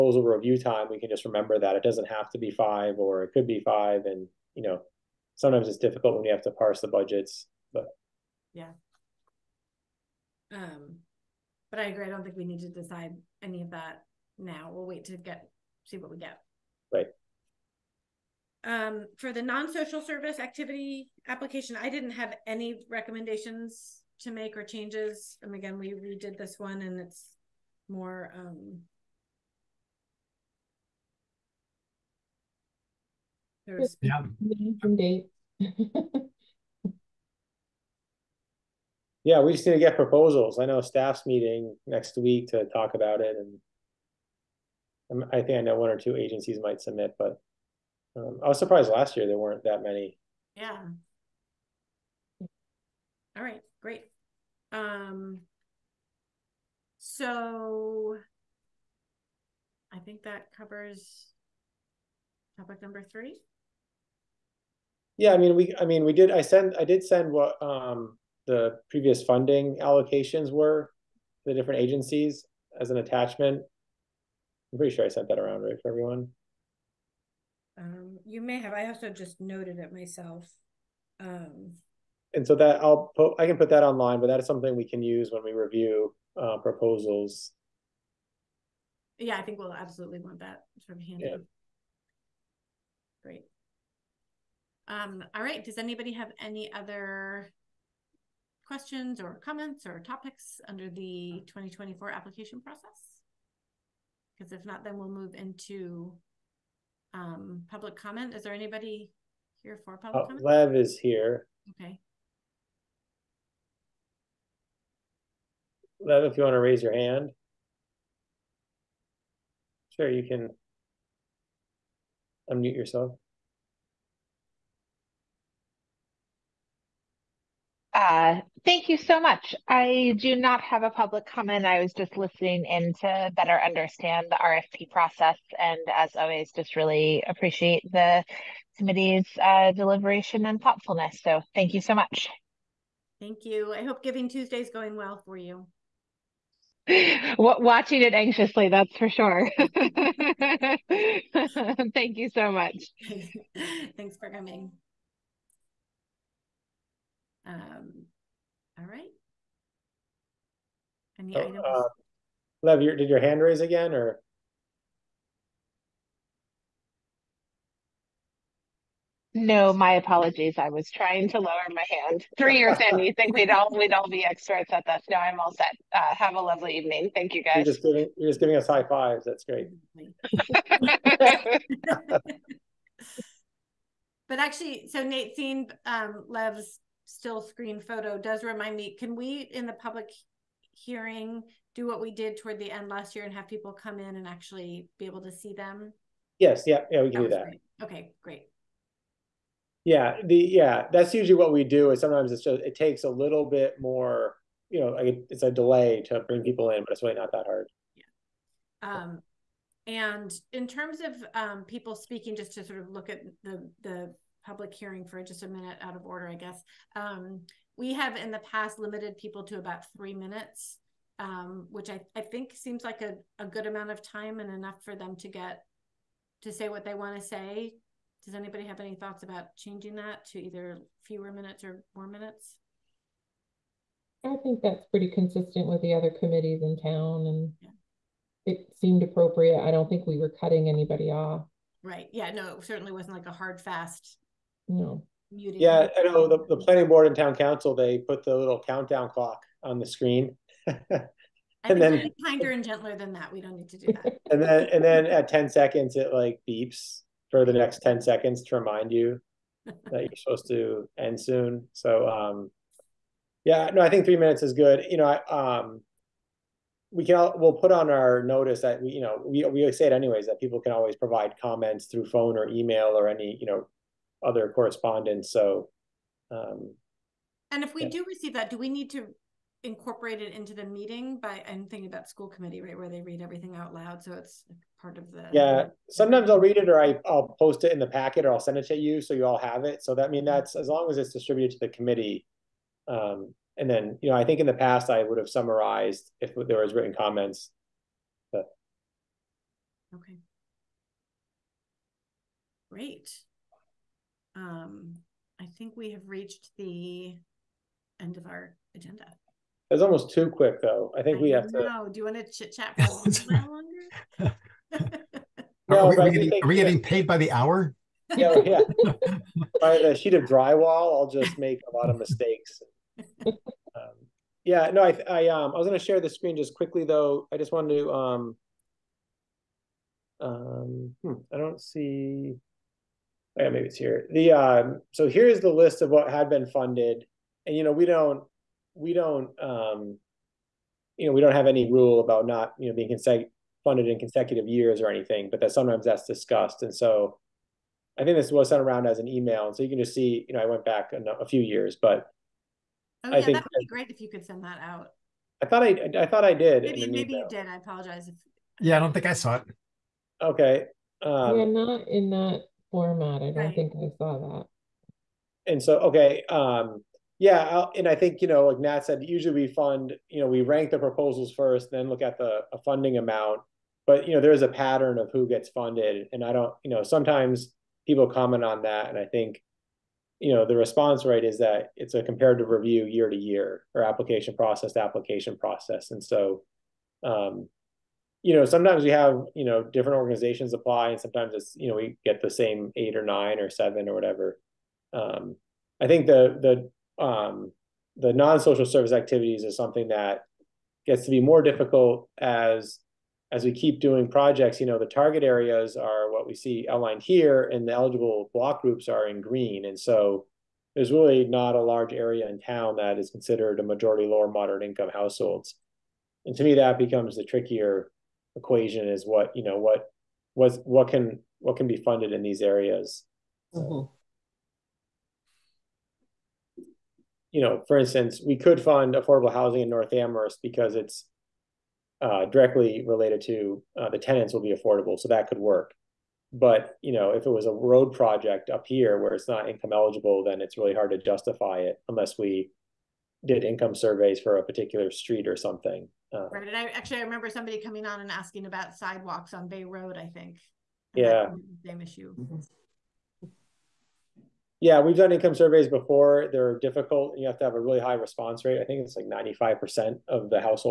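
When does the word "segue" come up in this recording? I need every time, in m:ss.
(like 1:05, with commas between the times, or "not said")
not said.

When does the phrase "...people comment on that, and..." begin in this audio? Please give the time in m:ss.
6:17.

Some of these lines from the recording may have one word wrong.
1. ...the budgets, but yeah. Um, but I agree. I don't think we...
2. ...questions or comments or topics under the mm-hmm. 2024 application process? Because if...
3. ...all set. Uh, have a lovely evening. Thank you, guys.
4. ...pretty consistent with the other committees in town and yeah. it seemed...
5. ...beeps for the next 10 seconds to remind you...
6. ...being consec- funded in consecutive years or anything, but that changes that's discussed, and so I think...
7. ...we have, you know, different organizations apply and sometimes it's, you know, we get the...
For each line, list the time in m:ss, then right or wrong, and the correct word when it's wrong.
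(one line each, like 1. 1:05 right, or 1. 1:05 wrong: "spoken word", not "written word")
1. 0:06 right
2. 1:38 right
3. 2:55 right
4. 3:54 right
5. 4:16 right
6. 5:42 wrong: "sometimes", not "changes"
7. 6:28 right.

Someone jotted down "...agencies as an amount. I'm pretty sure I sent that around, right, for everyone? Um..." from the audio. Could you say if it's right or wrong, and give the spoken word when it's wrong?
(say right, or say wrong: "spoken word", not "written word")
wrong: "attachment", not "amount".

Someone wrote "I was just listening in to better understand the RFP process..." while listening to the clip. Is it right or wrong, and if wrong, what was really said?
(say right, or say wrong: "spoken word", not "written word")
right.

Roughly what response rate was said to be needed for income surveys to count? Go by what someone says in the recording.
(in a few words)
95%.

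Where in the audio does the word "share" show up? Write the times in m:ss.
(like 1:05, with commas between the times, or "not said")
5:25.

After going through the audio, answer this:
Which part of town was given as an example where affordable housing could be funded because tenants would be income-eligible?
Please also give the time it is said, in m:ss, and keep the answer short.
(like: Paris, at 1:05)
North Amherst, at 7:09.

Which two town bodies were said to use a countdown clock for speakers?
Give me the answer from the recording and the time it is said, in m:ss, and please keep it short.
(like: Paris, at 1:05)
Planning board and town council, at 4:06.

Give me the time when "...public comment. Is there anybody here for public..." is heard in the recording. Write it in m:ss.
1:47.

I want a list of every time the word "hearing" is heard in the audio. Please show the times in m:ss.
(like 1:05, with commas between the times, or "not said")
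3:10, 3:34.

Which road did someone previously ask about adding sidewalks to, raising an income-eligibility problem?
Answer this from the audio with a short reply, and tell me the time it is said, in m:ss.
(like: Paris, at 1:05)
Bay Road, at 7:29.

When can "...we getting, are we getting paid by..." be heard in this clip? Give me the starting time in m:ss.
5:16.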